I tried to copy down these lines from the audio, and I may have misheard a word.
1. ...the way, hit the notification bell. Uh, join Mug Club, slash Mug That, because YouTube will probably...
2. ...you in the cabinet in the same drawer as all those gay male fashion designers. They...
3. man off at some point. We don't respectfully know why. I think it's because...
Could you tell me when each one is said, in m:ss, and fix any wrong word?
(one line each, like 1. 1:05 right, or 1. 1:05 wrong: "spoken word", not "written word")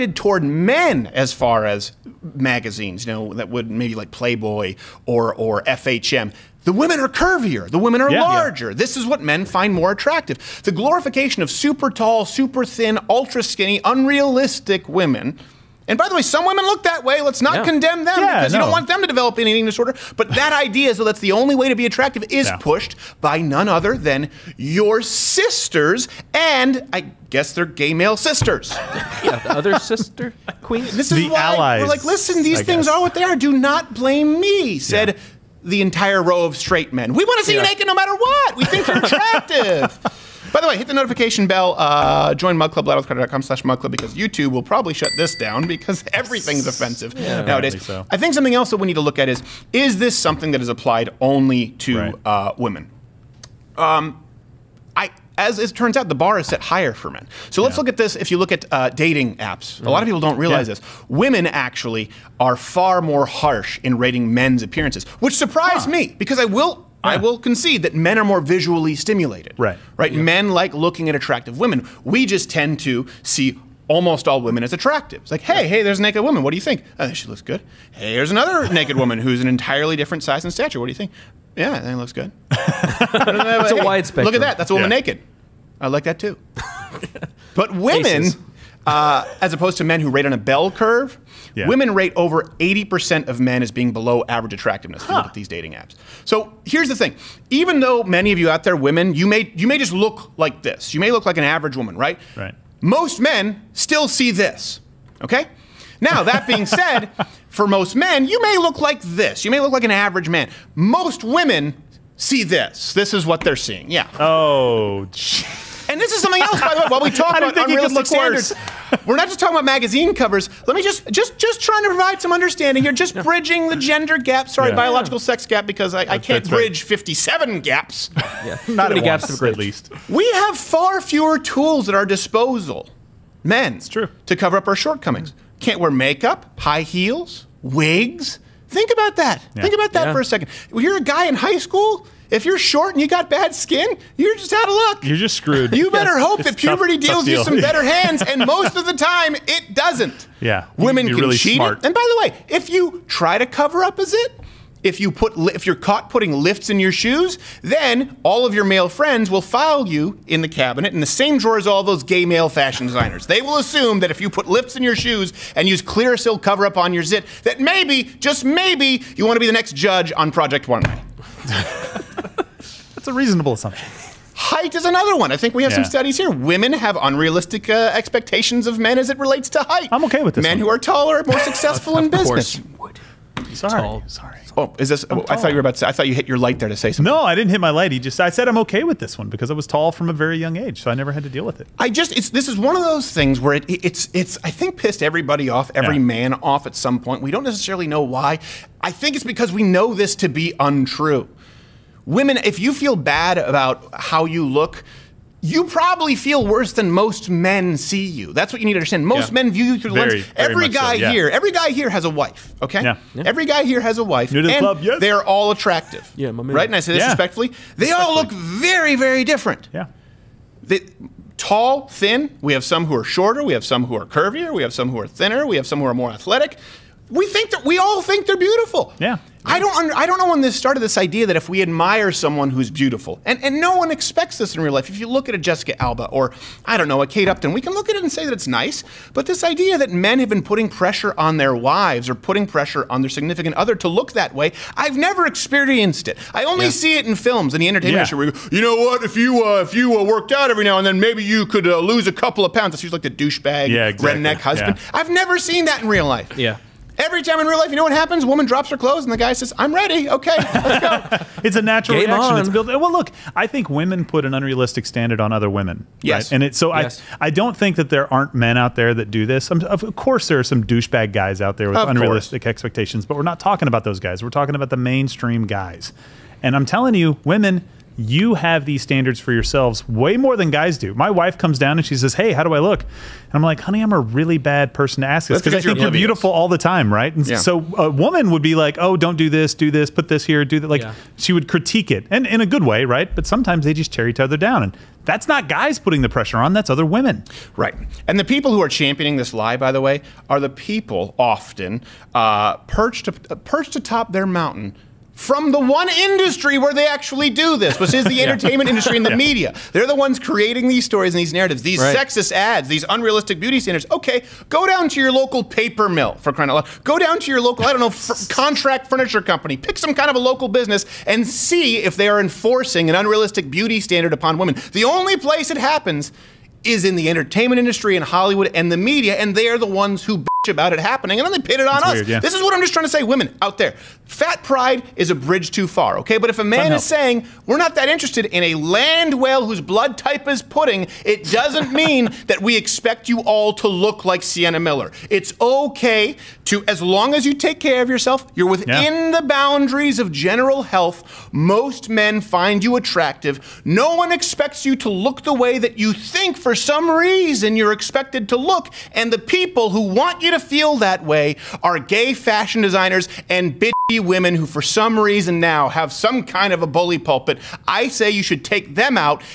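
1. 0:40 wrong: "Club", not "That"
2. 2:39 right
3. 3:16 wrong: "necessarily", not "respectfully".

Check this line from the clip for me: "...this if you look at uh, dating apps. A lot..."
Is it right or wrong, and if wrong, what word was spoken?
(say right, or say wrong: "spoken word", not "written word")
right.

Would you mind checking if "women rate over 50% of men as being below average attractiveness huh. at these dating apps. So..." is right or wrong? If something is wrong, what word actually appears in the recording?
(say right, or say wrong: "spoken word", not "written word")
wrong: "80", not "50".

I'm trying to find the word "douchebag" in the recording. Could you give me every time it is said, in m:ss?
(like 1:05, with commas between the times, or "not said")
4:13, 4:30.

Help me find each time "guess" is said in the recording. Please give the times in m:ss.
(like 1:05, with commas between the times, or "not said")
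0:27, 0:32.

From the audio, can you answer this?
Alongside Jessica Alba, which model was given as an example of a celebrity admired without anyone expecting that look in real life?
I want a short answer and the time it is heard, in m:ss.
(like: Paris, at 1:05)
Kate Upton, at 3:57.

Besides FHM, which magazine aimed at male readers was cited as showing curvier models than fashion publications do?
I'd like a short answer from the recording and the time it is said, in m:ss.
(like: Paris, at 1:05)
Playboy, at 0:04.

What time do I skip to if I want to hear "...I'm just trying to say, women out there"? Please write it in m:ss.
5:32.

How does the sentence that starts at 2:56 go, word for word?
Women have unrealistic uh, expectations of men as it relates to height.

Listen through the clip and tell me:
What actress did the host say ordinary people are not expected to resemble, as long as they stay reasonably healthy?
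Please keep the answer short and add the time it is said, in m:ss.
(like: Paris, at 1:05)
Sienna Miller, at 5:44.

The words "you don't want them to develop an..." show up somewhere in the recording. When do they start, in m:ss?
0:18.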